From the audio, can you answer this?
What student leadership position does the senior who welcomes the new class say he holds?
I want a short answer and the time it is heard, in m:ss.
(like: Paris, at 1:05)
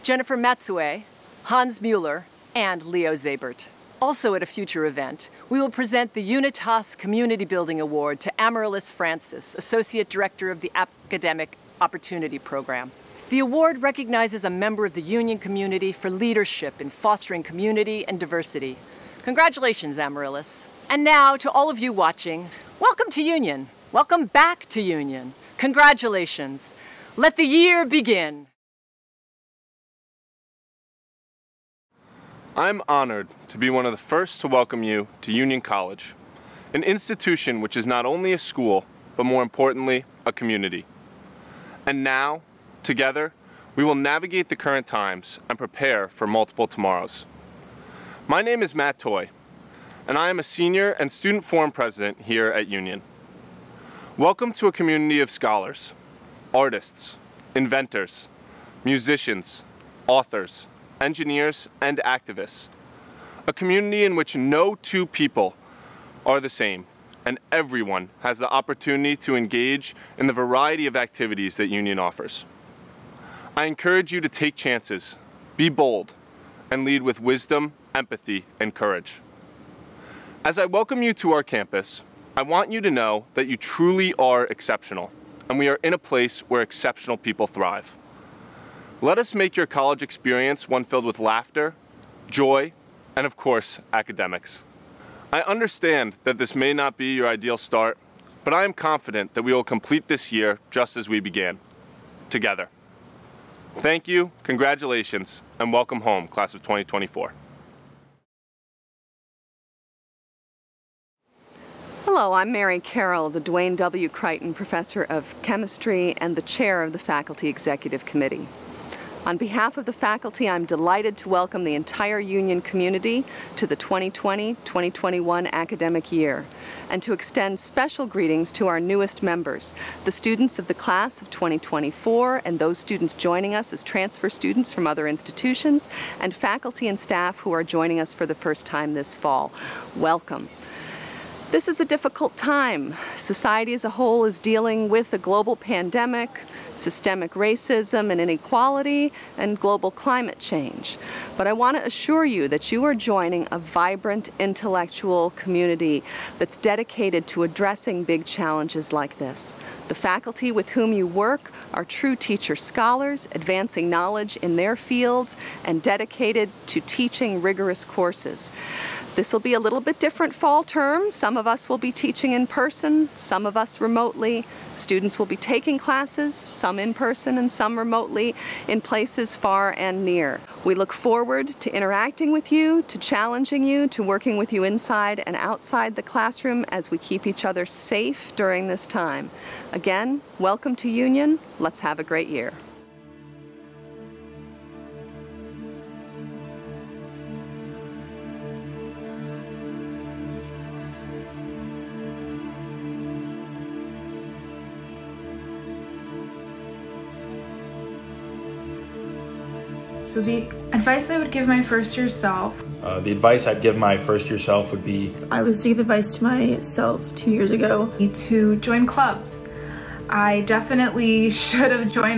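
Student forum president, at 0:51.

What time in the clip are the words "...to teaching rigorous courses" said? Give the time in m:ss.
2:46.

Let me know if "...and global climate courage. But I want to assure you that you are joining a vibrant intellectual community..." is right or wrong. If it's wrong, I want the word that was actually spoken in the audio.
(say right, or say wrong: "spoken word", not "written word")
wrong: "change", not "courage".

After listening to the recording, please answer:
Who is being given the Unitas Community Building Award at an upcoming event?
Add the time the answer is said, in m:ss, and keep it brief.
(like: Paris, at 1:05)
Amaryllis Francis, at 0:08.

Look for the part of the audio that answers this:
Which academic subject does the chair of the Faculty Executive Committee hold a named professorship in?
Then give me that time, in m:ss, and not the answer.
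1:55.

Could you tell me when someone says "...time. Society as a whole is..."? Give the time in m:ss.
2:22.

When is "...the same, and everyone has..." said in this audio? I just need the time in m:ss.
1:06.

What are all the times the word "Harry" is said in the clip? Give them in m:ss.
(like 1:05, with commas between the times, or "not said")
not said.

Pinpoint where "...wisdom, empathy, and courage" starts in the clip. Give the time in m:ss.
1:17.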